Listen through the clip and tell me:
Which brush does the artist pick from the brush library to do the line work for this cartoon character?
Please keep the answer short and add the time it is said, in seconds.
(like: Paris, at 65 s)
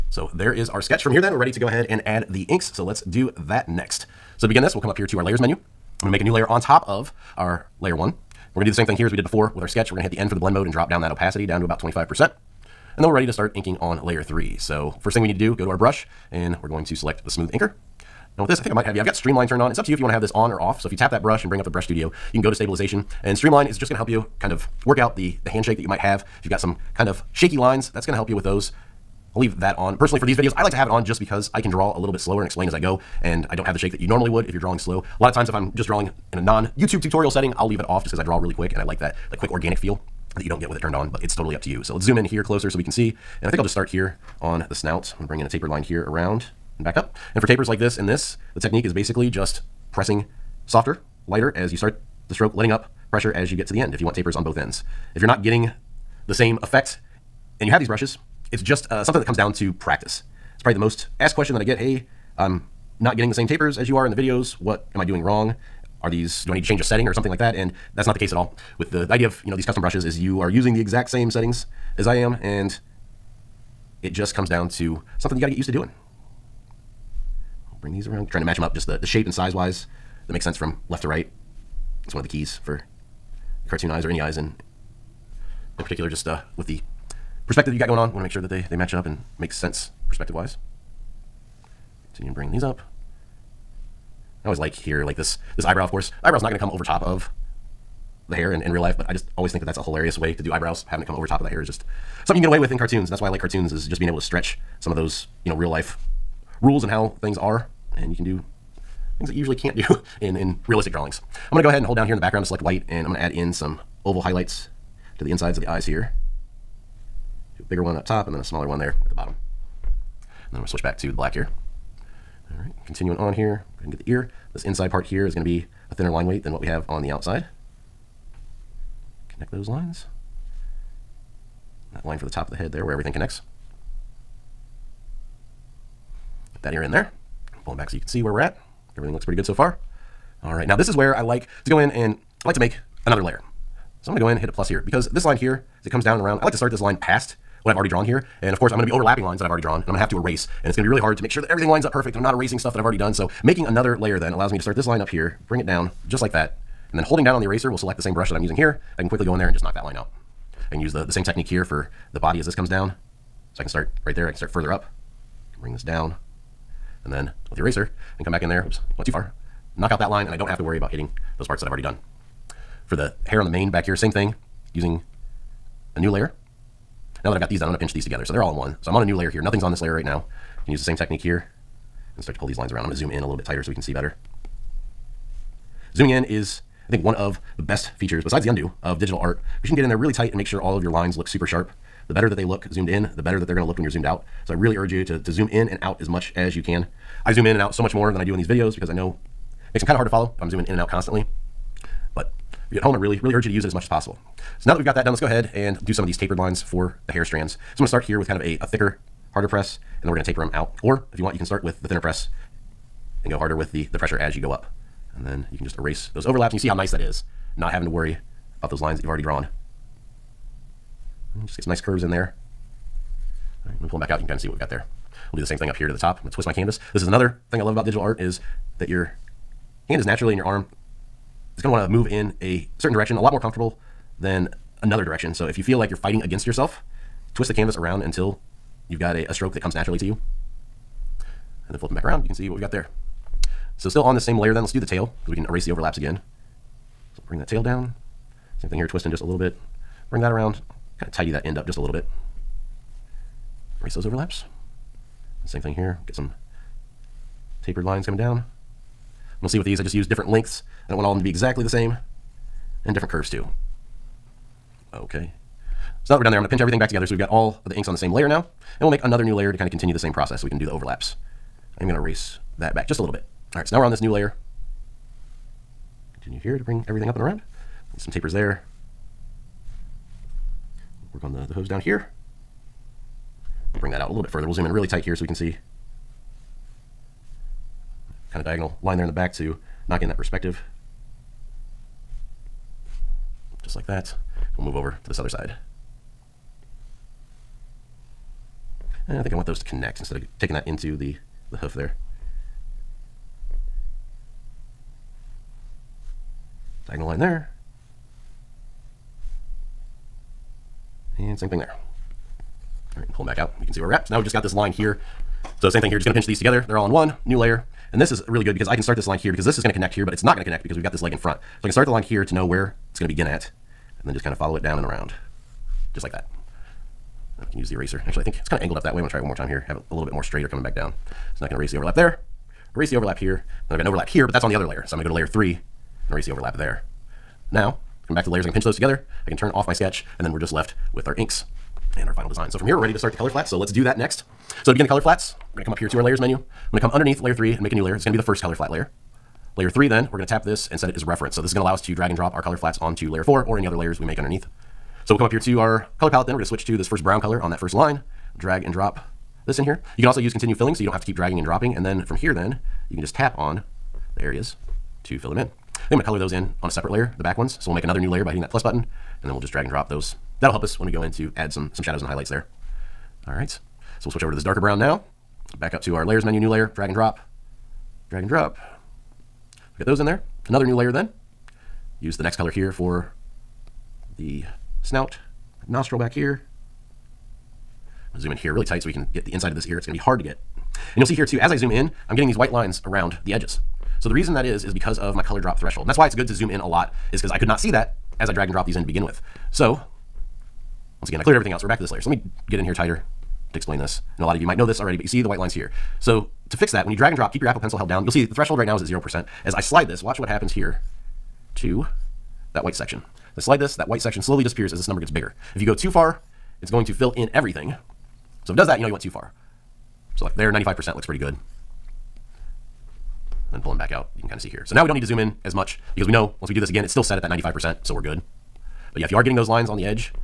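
smooth inker, at 17 s.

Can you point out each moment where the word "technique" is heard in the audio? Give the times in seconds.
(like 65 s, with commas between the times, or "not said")
48 s, 161 s, 180 s.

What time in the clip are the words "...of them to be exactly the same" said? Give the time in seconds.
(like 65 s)
261 s.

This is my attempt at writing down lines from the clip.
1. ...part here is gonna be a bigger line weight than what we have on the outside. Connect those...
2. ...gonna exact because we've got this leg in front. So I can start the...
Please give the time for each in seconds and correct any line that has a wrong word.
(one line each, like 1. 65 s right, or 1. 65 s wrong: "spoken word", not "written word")
1. 124 s wrong: "thinner", not "bigger"
2. 320 s wrong: "connect", not "exact".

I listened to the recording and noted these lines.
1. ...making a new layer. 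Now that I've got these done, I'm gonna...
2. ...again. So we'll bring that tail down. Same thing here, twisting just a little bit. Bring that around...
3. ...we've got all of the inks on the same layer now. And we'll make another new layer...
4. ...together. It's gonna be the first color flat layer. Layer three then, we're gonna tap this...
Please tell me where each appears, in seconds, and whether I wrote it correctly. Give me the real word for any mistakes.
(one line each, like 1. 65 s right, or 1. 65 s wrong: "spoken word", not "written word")
1. 174 s wrong: "using", not "making"
2. 245 s right
3. 267 s right
4. 347 s wrong: "layer", not "together".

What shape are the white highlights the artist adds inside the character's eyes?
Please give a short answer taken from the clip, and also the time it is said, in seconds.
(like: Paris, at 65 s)
oval, at 114 s.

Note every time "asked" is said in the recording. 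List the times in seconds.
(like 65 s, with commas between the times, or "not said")
61 s.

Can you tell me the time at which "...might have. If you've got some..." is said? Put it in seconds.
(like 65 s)
25 s.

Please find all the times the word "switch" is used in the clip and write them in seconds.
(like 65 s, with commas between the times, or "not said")
120 s, 356 s, 374 s.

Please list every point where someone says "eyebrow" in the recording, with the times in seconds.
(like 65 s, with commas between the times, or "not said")
95 s, 100 s.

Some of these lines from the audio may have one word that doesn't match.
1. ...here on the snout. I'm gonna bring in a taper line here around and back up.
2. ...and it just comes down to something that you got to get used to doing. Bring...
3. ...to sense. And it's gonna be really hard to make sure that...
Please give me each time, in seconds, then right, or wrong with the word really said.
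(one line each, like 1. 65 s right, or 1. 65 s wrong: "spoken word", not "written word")
1. 43 s right
2. 72 s right
3. 150 s wrong: "erase", not "sense".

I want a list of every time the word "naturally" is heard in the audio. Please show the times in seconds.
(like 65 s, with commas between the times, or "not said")
230 s, 239 s.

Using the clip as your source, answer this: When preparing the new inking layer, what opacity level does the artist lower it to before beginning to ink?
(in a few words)
25%.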